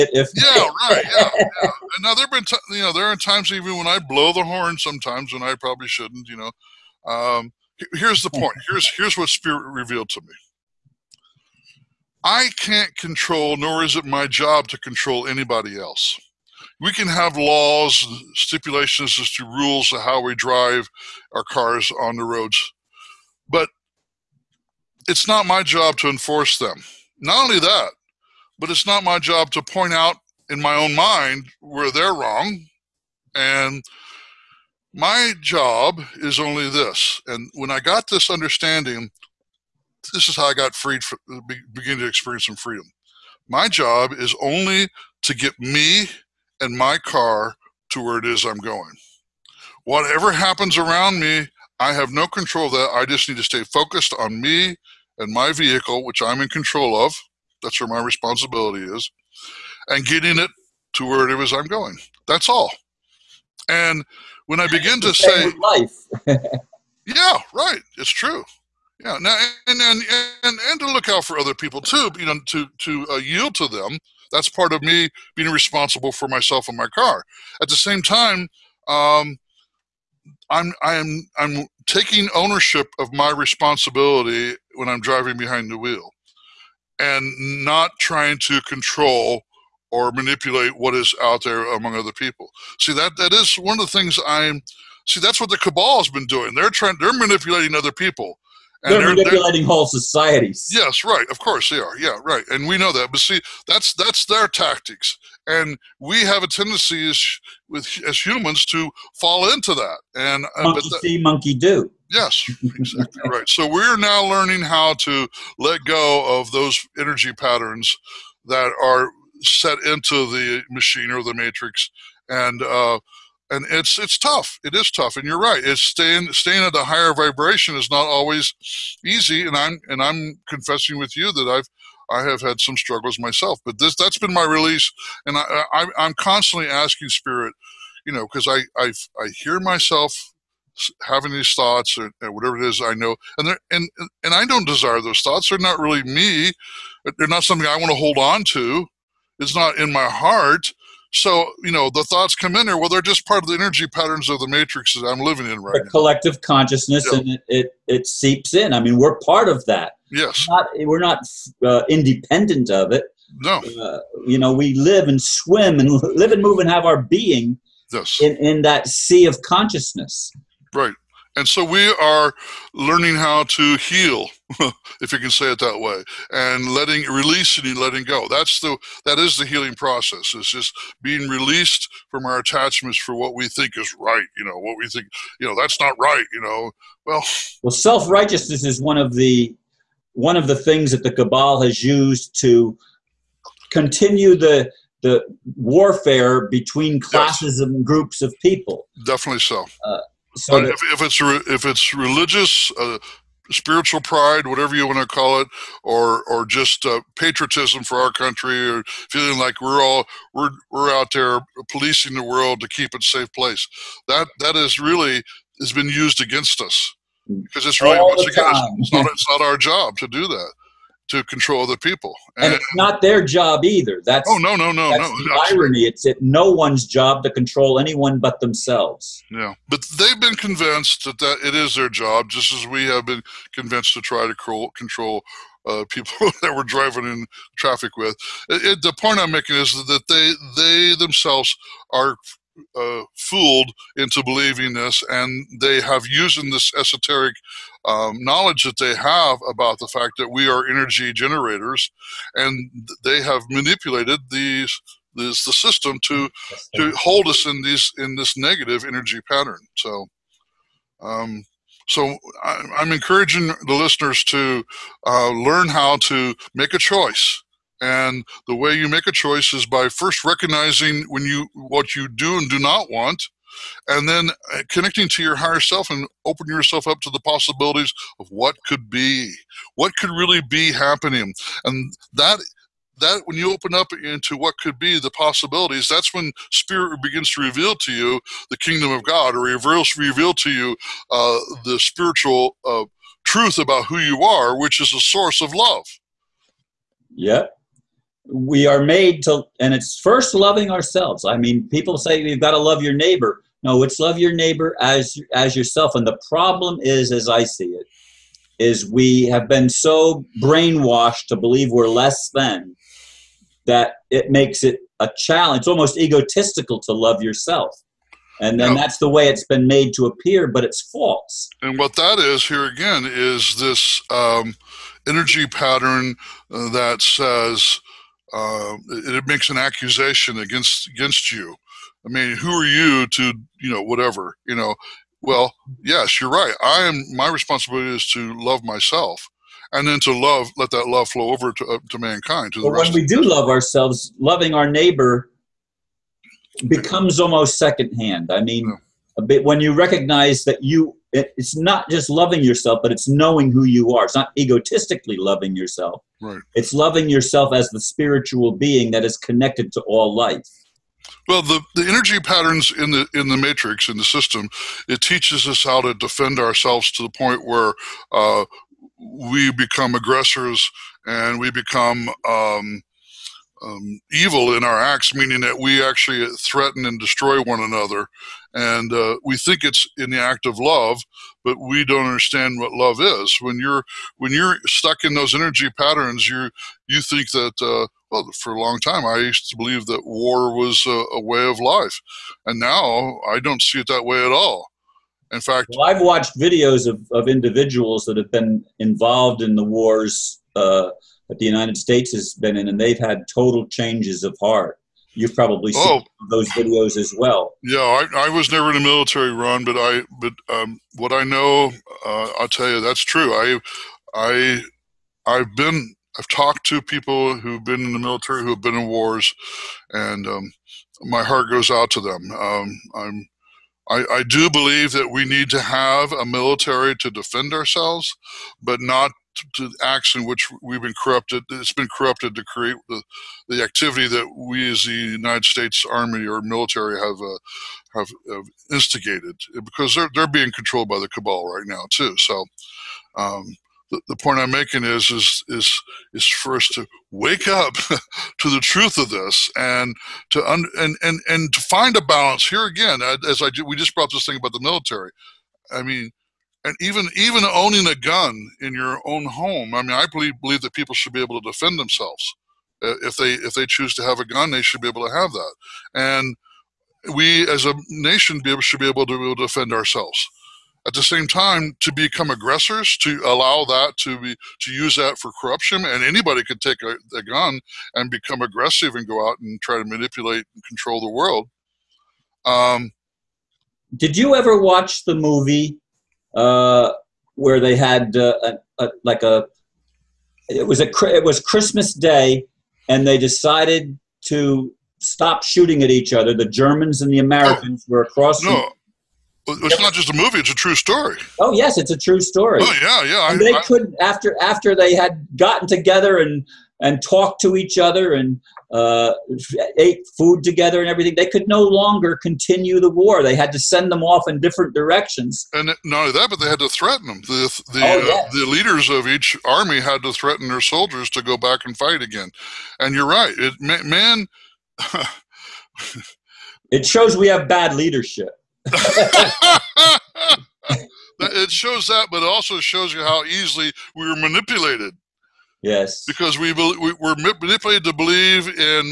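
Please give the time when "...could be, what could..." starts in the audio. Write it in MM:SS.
04:38.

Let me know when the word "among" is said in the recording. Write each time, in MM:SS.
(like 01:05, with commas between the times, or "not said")
01:31.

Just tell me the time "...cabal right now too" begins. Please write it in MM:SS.
07:21.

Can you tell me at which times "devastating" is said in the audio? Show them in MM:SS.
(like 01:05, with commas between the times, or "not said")
not said.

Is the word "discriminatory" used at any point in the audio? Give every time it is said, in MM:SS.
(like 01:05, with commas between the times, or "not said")
not said.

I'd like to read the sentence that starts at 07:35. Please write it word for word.
I mean, and even even owning a gun in your own home.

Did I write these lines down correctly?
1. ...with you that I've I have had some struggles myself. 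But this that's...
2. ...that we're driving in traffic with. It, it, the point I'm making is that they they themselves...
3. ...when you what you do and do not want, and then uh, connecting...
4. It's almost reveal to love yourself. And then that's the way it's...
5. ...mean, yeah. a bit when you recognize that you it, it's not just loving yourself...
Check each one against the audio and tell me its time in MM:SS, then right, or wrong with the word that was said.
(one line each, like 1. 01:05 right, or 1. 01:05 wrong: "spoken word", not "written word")
1. 02:10 right
2. 03:56 right
3. 04:31 right
4. 05:15 wrong: "egotistical", not "reveal"
5. 05:48 right.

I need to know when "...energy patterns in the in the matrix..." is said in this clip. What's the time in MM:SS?
06:01.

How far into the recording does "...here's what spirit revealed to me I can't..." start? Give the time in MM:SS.
00:08.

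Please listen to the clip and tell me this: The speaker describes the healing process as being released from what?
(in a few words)
Our attachments.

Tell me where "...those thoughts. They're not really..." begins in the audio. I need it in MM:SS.
02:25.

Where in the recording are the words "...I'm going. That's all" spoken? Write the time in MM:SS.
01:01.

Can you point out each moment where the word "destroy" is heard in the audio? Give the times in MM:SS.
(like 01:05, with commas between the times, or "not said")
06:16.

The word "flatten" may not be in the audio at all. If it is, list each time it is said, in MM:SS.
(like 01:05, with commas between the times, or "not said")
not said.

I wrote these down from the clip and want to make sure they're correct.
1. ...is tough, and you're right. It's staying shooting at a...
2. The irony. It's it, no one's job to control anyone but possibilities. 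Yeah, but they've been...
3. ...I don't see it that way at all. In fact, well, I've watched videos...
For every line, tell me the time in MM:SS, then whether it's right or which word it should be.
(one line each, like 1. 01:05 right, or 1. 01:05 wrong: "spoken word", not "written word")
1. 02:04 wrong: "staying", not "shooting"
2. 03:44 wrong: "themselves", not "possibilities"
3. 06:33 right.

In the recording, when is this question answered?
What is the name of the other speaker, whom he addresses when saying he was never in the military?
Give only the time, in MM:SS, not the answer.
06:49.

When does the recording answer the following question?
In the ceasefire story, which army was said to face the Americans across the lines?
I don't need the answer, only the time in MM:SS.
08:16.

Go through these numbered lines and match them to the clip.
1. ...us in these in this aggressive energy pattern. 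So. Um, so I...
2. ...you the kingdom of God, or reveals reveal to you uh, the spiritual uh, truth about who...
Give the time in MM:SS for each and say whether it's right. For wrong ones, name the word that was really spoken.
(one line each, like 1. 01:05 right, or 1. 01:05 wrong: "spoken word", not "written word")
1. 04:17 wrong: "negative", not "aggressive"
2. 04:47 right.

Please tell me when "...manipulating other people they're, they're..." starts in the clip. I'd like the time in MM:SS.
01:37.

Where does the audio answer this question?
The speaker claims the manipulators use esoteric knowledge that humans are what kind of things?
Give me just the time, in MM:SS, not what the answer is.
04:10.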